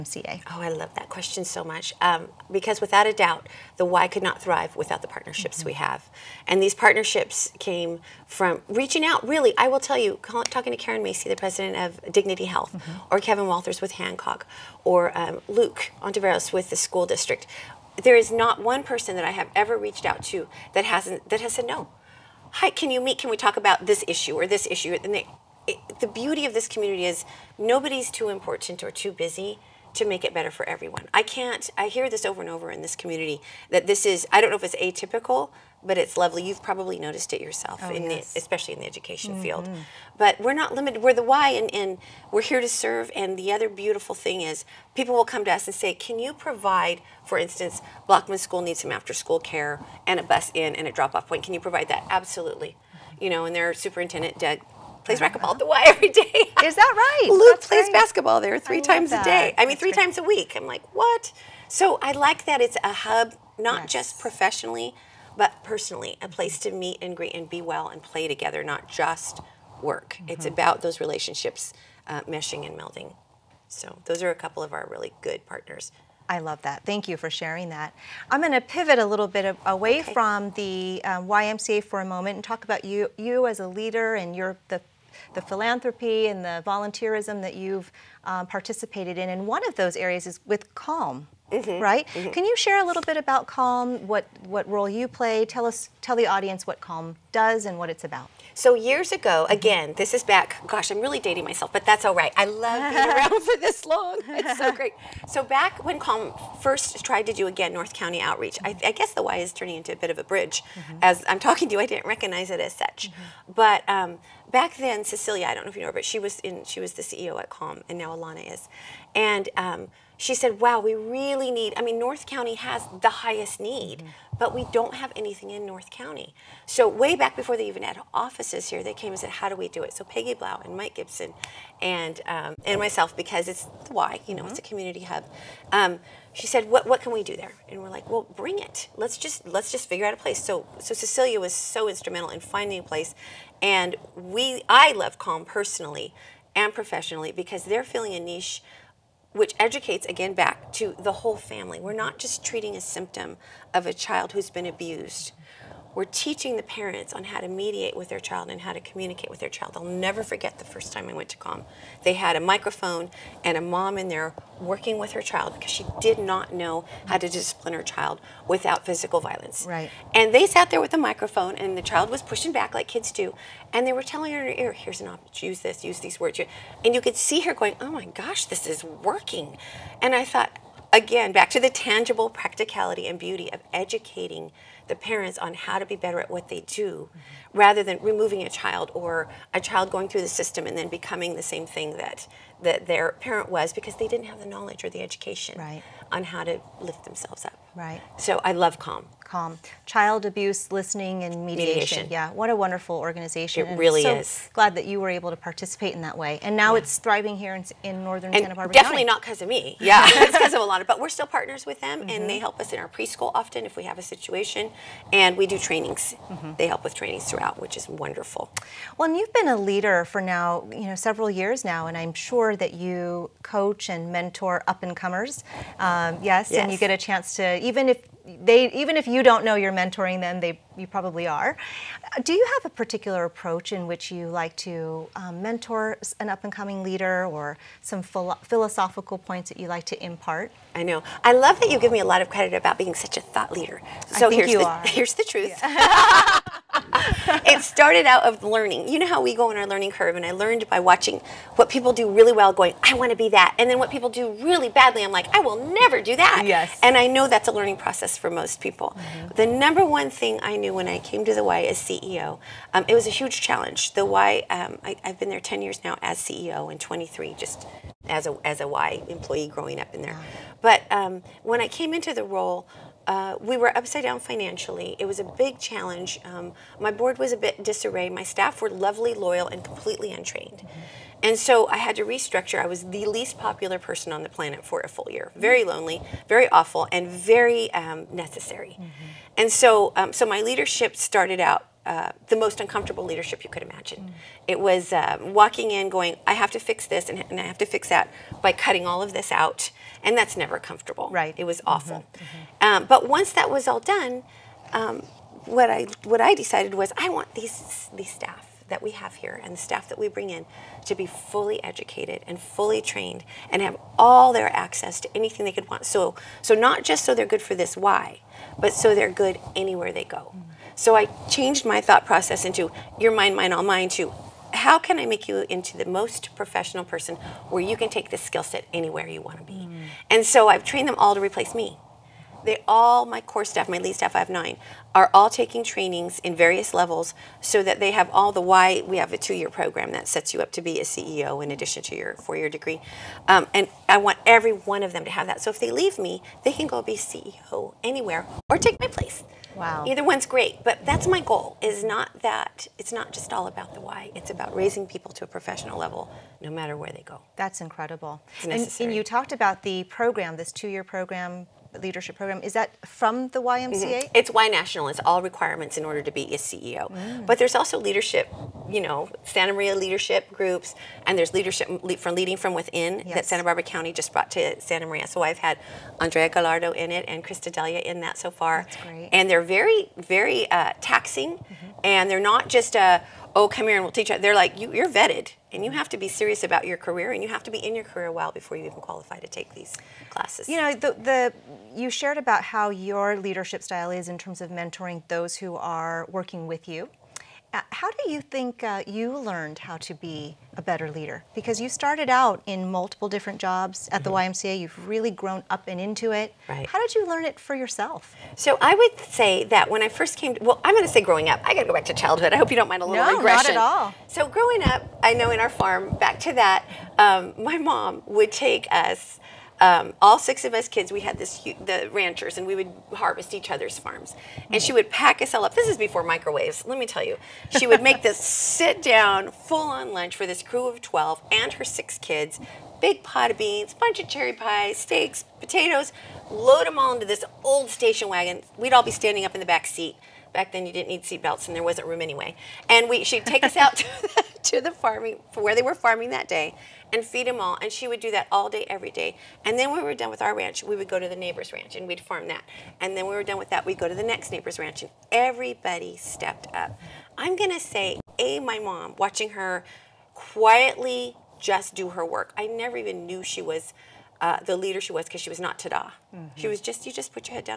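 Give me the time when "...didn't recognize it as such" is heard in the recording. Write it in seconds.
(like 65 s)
111 s.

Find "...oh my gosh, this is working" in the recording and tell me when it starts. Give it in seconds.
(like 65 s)
177 s.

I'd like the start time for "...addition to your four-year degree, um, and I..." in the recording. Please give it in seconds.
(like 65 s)
341 s.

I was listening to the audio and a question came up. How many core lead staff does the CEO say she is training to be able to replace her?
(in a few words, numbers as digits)
9.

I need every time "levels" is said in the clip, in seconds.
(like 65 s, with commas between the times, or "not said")
336 s, 355 s.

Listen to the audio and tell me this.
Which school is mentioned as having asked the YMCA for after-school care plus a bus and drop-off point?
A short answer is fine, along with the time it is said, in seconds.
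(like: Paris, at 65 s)
Blochman School, at 48 s.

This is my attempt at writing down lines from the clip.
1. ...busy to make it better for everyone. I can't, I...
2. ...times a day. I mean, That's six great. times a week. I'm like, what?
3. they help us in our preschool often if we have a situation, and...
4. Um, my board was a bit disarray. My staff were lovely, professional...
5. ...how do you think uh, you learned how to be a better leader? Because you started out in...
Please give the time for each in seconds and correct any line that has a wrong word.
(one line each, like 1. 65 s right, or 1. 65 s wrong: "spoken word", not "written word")
1. 29 s right
2. 58 s wrong: "three", not "six"
3. 212 s right
4. 276 s wrong: "loyal", not "professional"
5. 397 s right.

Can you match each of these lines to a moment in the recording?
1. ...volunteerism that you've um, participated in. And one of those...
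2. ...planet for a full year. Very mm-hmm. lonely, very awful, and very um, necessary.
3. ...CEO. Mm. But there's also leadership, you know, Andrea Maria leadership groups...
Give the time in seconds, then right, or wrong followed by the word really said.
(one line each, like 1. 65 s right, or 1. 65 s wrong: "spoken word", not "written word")
1. 86 s right
2. 284 s right
3. 366 s wrong: "Santa", not "Andrea".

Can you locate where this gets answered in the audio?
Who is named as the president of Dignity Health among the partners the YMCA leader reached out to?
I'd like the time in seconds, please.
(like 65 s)
10 s.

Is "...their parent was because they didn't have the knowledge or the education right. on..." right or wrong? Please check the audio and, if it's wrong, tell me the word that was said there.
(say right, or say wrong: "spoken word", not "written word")
right.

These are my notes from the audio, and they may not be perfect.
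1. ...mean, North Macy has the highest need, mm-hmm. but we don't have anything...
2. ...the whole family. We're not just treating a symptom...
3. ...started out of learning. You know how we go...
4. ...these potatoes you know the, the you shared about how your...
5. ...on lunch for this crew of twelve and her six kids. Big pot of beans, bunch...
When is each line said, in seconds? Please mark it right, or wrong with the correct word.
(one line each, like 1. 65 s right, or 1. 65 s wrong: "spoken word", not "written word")
1. 121 s wrong: "County", not "Macy"
2. 150 s right
3. 247 s right
4. 389 s wrong: "classes", not "potatoes"
5. 429 s right.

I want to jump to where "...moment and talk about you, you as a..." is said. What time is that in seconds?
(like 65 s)
82 s.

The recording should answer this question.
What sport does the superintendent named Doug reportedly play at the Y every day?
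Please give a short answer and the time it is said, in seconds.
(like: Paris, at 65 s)
racquetball, at 55 s.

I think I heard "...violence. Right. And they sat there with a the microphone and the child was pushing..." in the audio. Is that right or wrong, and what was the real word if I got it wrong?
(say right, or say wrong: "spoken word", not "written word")
right.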